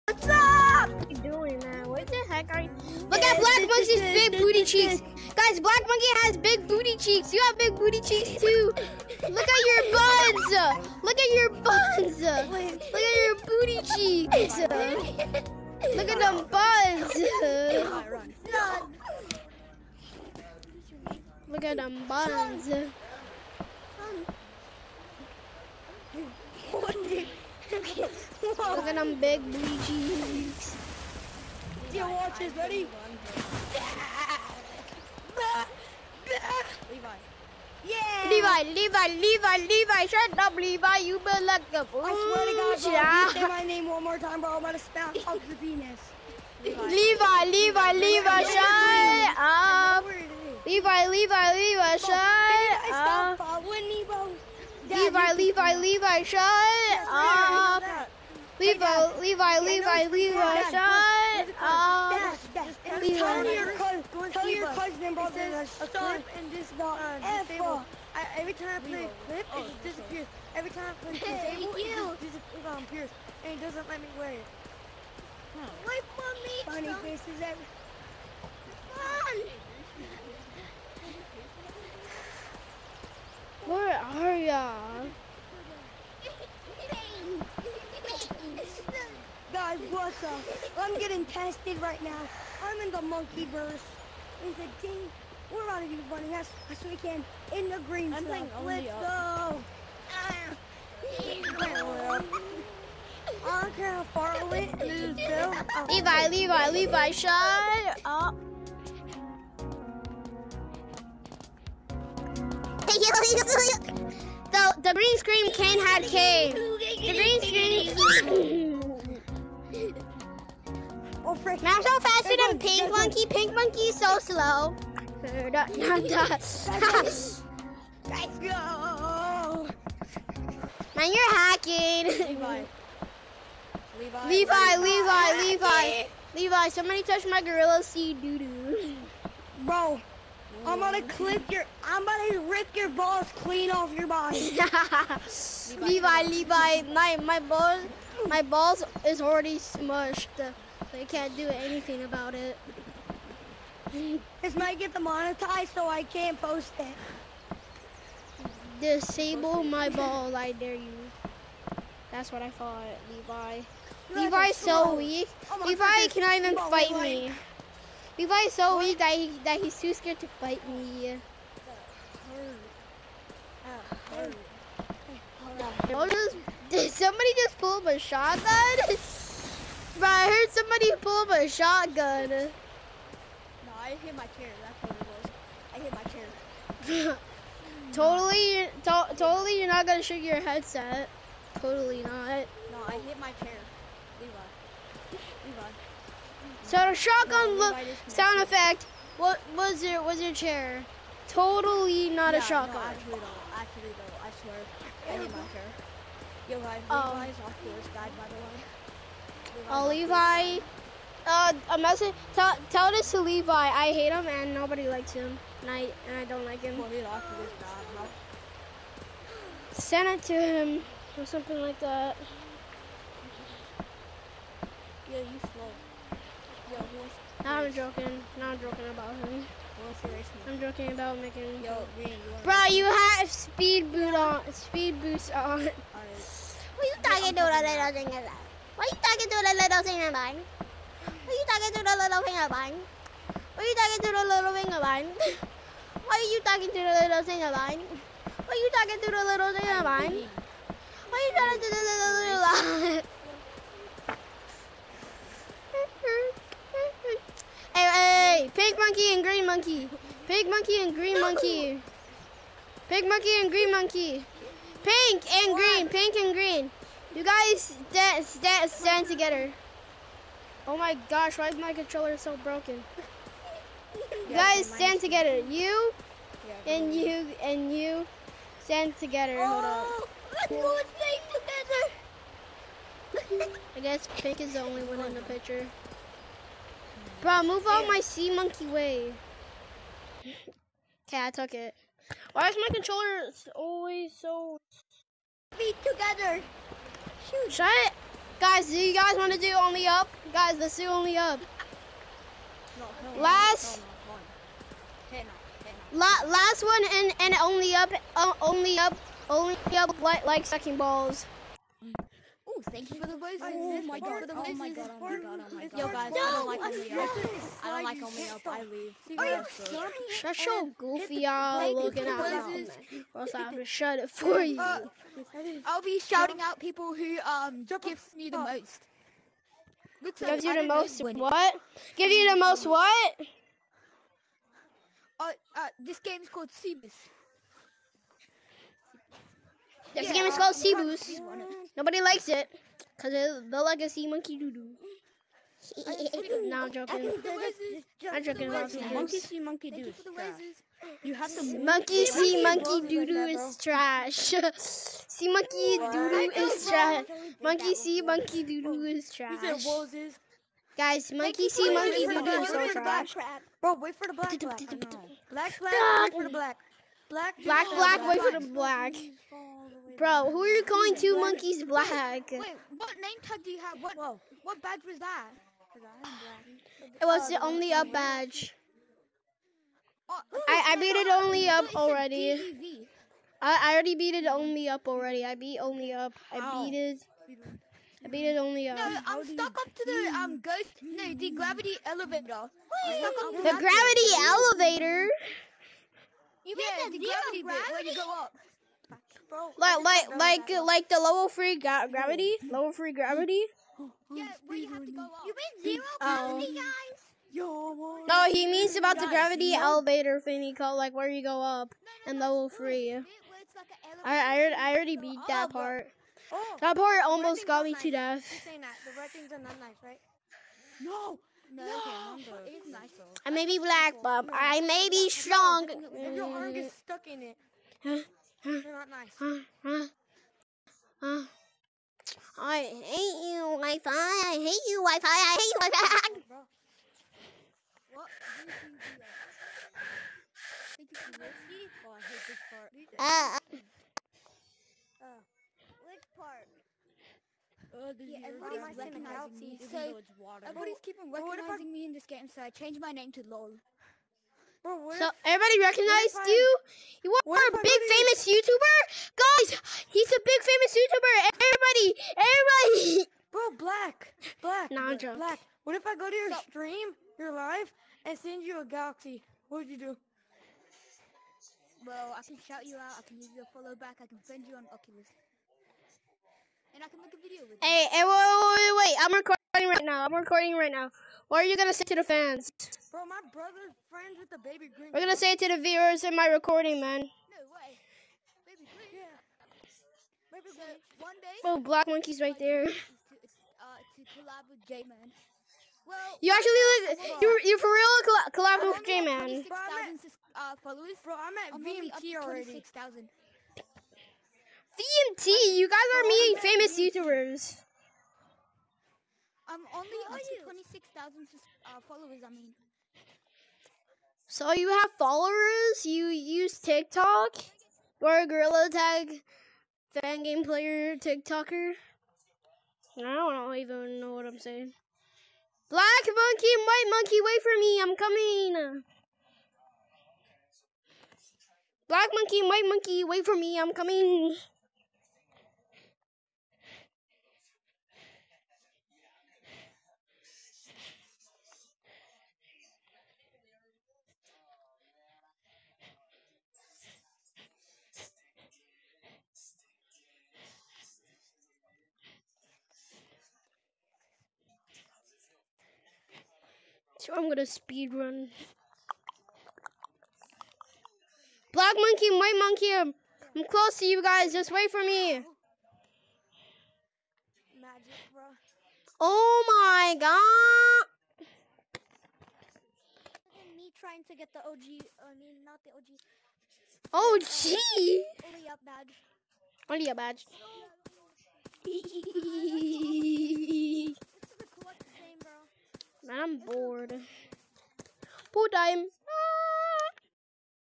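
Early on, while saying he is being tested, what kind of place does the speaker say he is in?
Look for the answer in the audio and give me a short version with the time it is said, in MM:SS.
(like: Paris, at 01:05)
the monkey verse, at 01:33.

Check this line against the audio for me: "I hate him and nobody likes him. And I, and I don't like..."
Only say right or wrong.
right.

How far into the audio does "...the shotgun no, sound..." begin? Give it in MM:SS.
03:16.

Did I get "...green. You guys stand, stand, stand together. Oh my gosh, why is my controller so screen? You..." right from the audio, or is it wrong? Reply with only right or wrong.
wrong.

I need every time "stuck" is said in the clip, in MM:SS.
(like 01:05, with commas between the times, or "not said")
06:29, 07:06.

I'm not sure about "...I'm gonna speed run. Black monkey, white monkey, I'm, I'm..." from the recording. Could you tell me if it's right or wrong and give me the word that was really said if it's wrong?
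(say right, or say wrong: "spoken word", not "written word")
right.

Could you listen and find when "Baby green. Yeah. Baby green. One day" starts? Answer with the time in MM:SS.
08:08.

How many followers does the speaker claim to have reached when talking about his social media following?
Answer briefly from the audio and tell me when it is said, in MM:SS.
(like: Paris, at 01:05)
26,000, at 08:30.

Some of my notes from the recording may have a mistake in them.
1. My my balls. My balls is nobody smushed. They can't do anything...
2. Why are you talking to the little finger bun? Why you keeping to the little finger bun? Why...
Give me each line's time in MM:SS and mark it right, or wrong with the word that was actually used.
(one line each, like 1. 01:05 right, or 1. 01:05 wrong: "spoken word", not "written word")
1. 02:26 wrong: "already", not "nobody"
2. 04:06 wrong: "talking", not "keeping".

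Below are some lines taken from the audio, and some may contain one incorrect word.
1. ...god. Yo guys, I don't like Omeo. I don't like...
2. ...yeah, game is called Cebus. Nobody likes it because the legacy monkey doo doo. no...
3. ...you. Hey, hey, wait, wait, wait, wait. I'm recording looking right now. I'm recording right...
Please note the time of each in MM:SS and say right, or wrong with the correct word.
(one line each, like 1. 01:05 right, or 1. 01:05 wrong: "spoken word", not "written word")
1. 05:15 right
2. 05:40 right
3. 07:57 wrong: "recording", not "looking".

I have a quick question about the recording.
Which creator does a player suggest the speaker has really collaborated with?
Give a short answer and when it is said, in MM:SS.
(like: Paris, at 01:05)
J Man, at 08:18.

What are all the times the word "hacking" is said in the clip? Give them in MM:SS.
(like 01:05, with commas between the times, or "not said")
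02:11.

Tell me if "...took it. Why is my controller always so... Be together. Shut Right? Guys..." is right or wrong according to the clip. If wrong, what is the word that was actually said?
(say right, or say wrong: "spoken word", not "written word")
right.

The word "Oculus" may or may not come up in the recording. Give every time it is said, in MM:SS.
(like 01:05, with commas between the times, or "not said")
07:54.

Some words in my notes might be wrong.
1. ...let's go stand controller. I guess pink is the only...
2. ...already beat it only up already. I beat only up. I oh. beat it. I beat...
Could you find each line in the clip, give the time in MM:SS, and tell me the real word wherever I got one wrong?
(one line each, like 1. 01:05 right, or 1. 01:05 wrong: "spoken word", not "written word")
1. 04:40 wrong: "together", not "controller"
2. 06:23 right.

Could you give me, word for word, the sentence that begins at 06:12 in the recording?
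Wait, what name tag do you have?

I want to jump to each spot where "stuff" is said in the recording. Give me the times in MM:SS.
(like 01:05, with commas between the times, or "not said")
01:38.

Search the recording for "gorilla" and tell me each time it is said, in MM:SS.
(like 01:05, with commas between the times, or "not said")
02:17, 08:38.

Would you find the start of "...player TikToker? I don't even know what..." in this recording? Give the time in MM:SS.
08:40.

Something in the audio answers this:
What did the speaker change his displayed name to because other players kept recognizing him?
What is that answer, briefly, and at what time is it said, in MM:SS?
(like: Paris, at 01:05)
LOL, at 07:33.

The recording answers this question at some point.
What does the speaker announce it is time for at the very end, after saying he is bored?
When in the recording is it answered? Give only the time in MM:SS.
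09:48.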